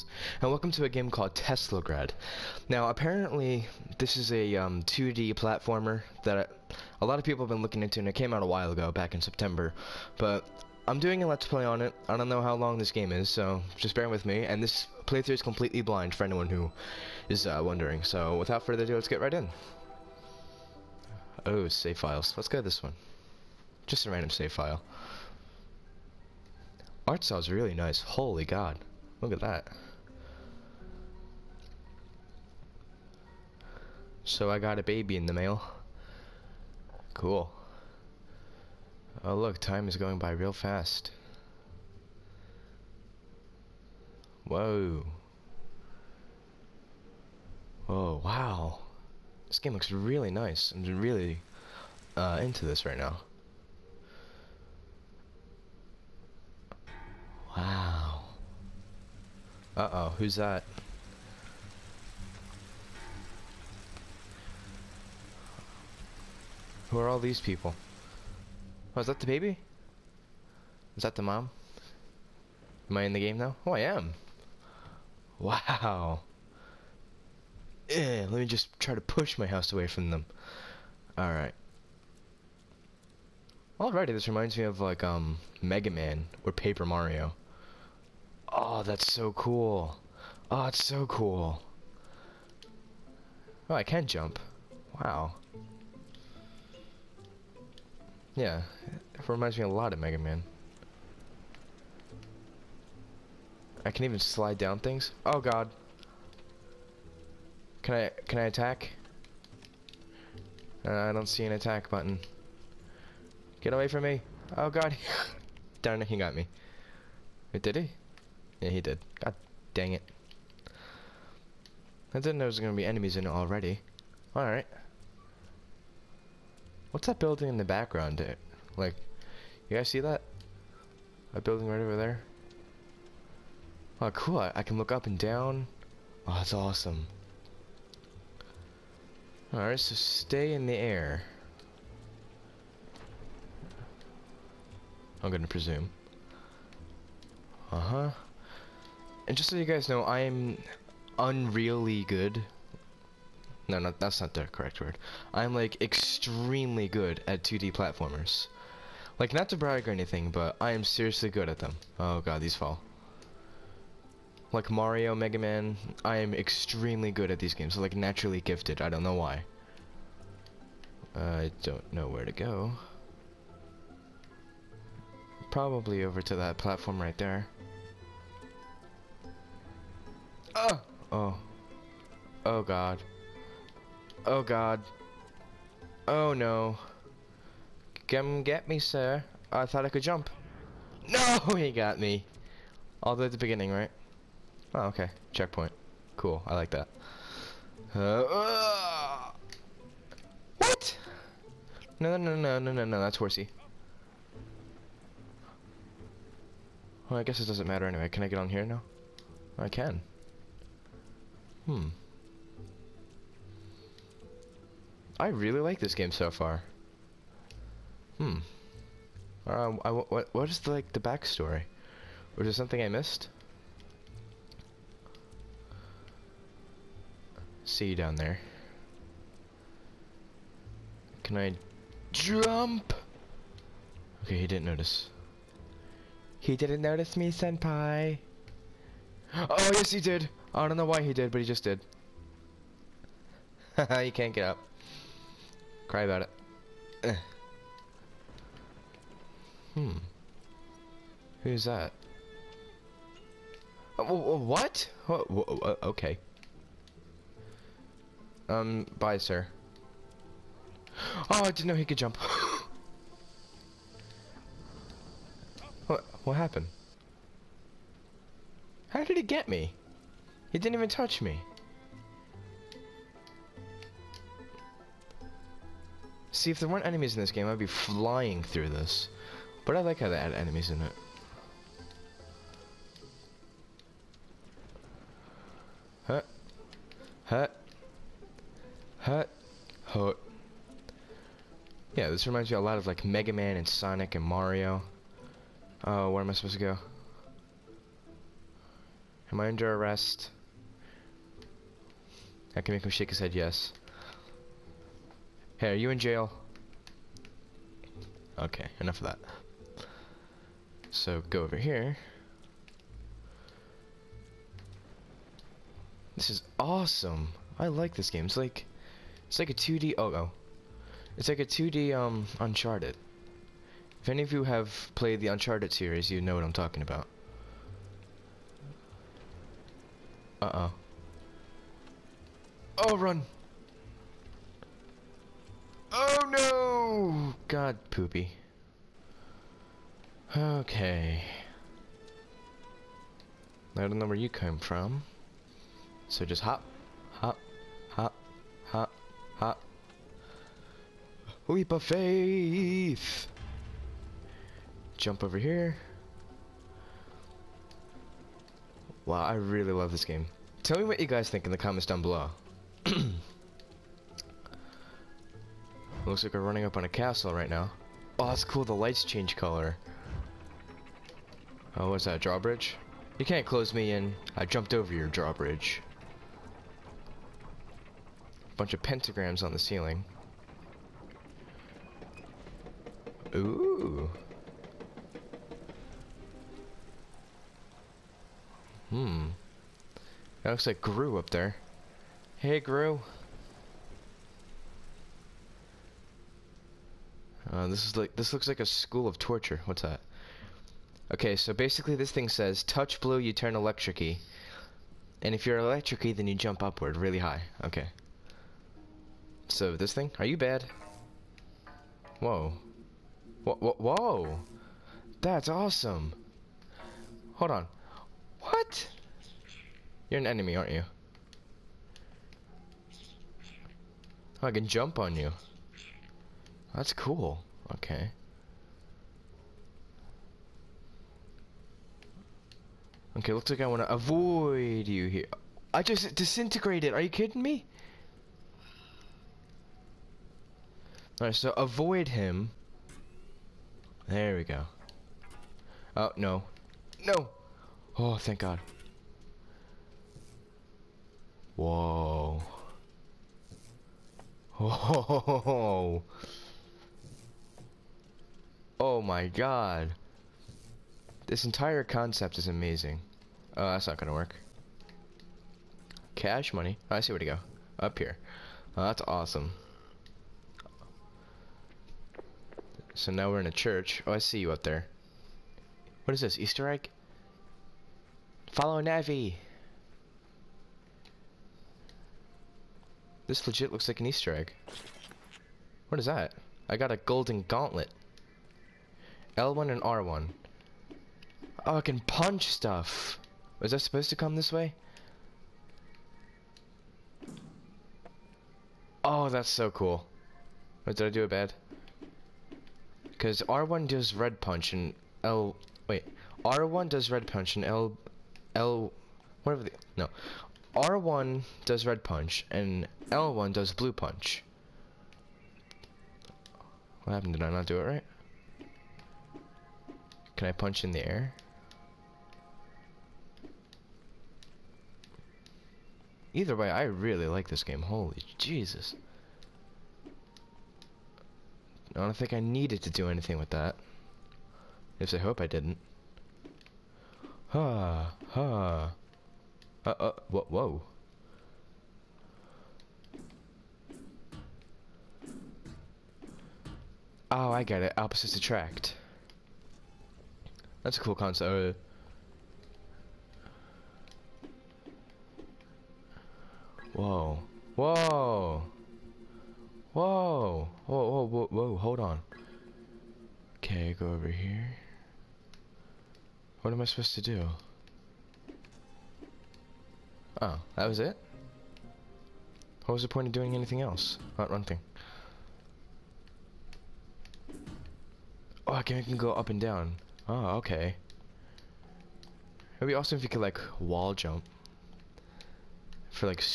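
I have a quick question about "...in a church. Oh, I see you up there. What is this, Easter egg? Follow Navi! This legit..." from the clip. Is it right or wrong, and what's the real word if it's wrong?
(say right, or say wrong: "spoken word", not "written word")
right.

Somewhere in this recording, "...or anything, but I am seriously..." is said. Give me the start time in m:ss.
2:39.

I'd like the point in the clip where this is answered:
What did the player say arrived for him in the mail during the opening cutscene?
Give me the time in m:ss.
0:34.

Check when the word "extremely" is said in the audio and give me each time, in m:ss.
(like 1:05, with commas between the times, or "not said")
2:35, 2:46.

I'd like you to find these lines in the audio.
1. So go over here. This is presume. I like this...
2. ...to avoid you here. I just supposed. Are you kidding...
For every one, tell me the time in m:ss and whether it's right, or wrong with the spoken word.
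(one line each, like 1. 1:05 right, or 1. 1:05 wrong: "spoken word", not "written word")
1. 5:10 wrong: "awesome", not "presume"
2. 7:13 wrong: "disintegrated", not "supposed".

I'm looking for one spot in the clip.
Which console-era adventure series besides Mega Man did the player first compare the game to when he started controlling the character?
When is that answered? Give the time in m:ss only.
1:26.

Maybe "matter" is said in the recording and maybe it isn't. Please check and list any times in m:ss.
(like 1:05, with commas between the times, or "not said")
3:27.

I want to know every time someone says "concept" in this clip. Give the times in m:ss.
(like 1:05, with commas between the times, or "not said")
7:41, 9:11.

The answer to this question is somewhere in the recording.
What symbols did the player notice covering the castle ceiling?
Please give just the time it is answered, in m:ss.
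6:18.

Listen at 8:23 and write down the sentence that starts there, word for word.
Because R1 does red punch and L...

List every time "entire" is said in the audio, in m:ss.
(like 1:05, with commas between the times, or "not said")
7:41.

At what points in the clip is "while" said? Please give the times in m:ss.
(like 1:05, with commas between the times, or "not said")
0:08.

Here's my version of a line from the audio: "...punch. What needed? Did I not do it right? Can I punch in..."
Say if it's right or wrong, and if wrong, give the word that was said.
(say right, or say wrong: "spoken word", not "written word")
wrong: "happened", not "needed".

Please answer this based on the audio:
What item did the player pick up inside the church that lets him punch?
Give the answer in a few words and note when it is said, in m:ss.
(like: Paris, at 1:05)
Golden gauntlet, at 8:06.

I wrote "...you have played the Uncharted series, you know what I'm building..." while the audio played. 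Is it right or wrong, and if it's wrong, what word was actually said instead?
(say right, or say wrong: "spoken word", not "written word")
wrong: "talking", not "building".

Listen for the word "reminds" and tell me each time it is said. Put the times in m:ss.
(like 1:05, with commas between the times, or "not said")
1:24, 1:39, 4:52.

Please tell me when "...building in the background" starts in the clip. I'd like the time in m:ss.
2:07.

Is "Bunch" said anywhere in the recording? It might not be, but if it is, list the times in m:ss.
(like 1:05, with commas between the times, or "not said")
6:18.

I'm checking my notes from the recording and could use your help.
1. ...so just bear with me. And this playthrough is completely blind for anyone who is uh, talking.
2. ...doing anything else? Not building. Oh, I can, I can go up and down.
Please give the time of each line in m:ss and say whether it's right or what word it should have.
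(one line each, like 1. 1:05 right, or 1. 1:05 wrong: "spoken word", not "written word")
1. 0:13 wrong: "wondering", not "talking"
2. 9:33 wrong: "running", not "building".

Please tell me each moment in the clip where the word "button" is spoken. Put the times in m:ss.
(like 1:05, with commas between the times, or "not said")
1:51.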